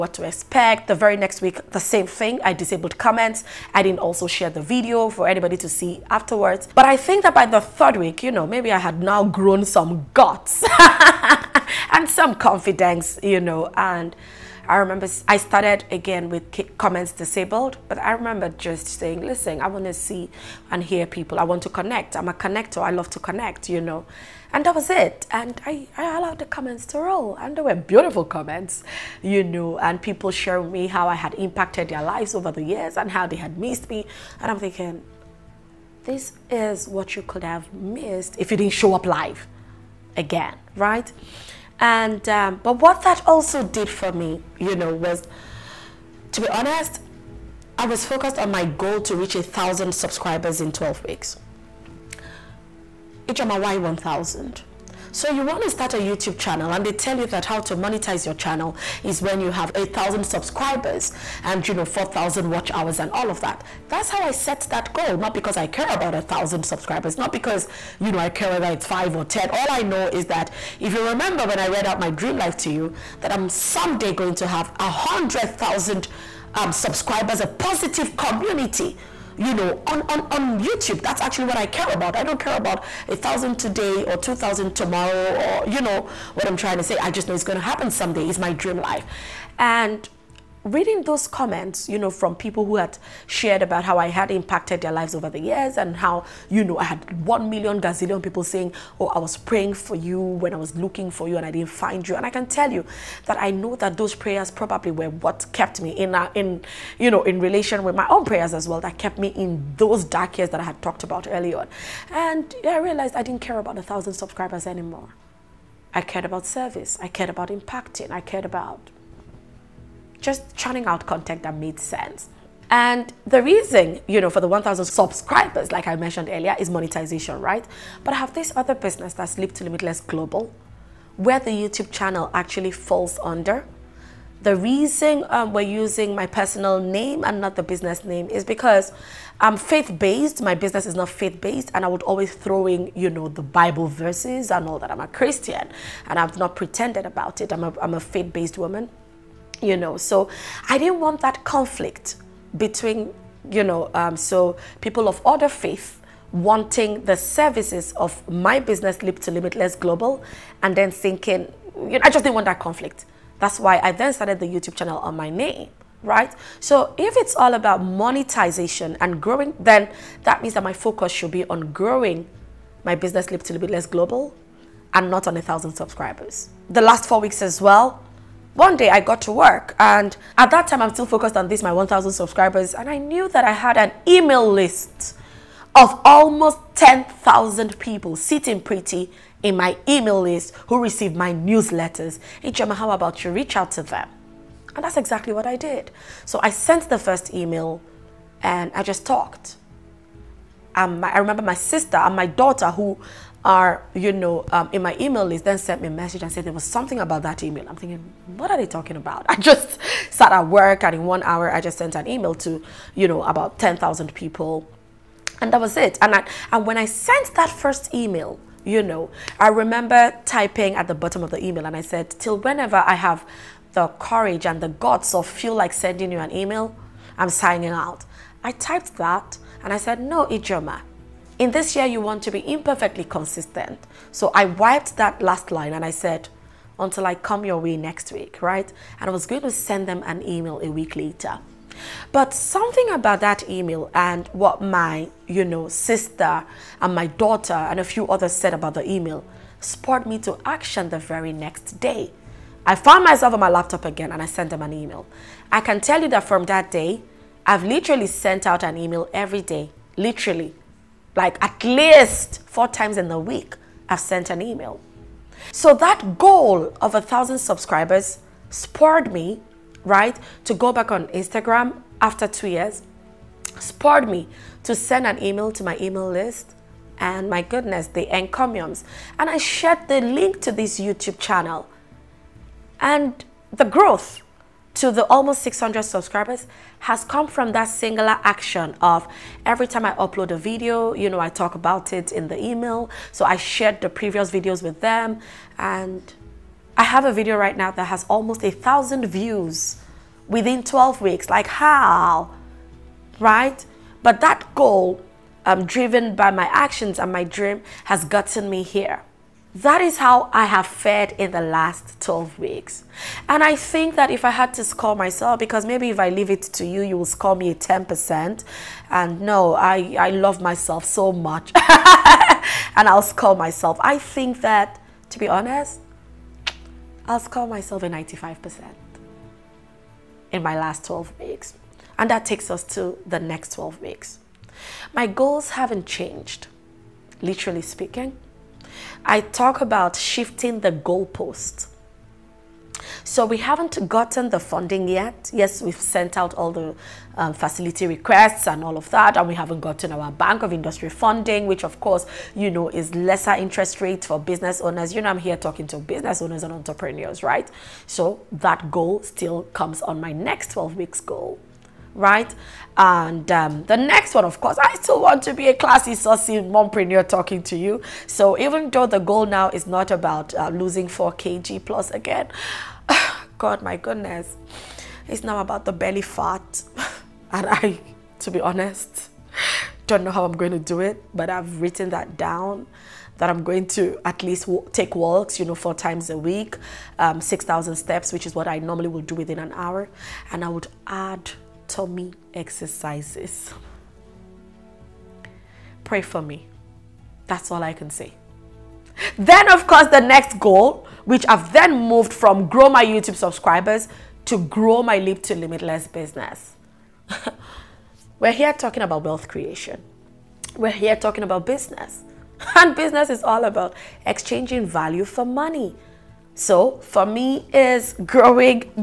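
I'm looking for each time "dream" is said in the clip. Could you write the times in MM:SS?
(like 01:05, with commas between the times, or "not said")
01:12, 01:28, 05:07.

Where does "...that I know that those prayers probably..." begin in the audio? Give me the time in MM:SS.
01:43.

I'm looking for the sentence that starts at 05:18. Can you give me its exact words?
And no, I, I love myself so much.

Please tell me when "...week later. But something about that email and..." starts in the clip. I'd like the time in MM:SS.
04:00.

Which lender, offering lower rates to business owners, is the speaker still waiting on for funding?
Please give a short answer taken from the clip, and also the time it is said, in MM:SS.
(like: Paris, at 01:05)
Bank of Industry, at 05:50.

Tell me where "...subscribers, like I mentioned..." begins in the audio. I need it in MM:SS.
02:04.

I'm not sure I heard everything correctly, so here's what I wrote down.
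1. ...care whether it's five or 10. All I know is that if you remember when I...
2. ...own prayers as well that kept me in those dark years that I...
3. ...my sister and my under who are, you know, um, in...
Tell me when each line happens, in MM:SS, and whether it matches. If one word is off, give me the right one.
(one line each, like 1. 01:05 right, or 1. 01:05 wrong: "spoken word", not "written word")
1. 01:08 right
2. 01:48 right
3. 03:21 wrong: "daughter", not "under".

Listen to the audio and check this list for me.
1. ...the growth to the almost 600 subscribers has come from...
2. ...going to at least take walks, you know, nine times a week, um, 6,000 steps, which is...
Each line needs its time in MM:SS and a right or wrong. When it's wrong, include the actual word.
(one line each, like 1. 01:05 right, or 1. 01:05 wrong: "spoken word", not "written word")
1. 04:43 right
2. 06:23 wrong: "four", not "nine".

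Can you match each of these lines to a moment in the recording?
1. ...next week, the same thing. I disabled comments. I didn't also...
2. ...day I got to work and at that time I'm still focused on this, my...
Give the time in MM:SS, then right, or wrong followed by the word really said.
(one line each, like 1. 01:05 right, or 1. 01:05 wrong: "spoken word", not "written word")
1. 00:01 right
2. 02:58 right.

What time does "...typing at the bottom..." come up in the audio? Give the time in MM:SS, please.
03:40.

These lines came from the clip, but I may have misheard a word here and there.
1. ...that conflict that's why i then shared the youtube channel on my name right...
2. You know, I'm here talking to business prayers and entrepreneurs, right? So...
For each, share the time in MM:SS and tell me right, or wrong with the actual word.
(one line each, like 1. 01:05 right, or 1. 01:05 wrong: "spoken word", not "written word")
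1. 02:42 wrong: "started", not "shared"
2. 05:54 wrong: "owners", not "prayers".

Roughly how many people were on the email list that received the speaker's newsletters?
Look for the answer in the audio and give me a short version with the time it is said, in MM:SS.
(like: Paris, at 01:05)
10,000, at 03:06.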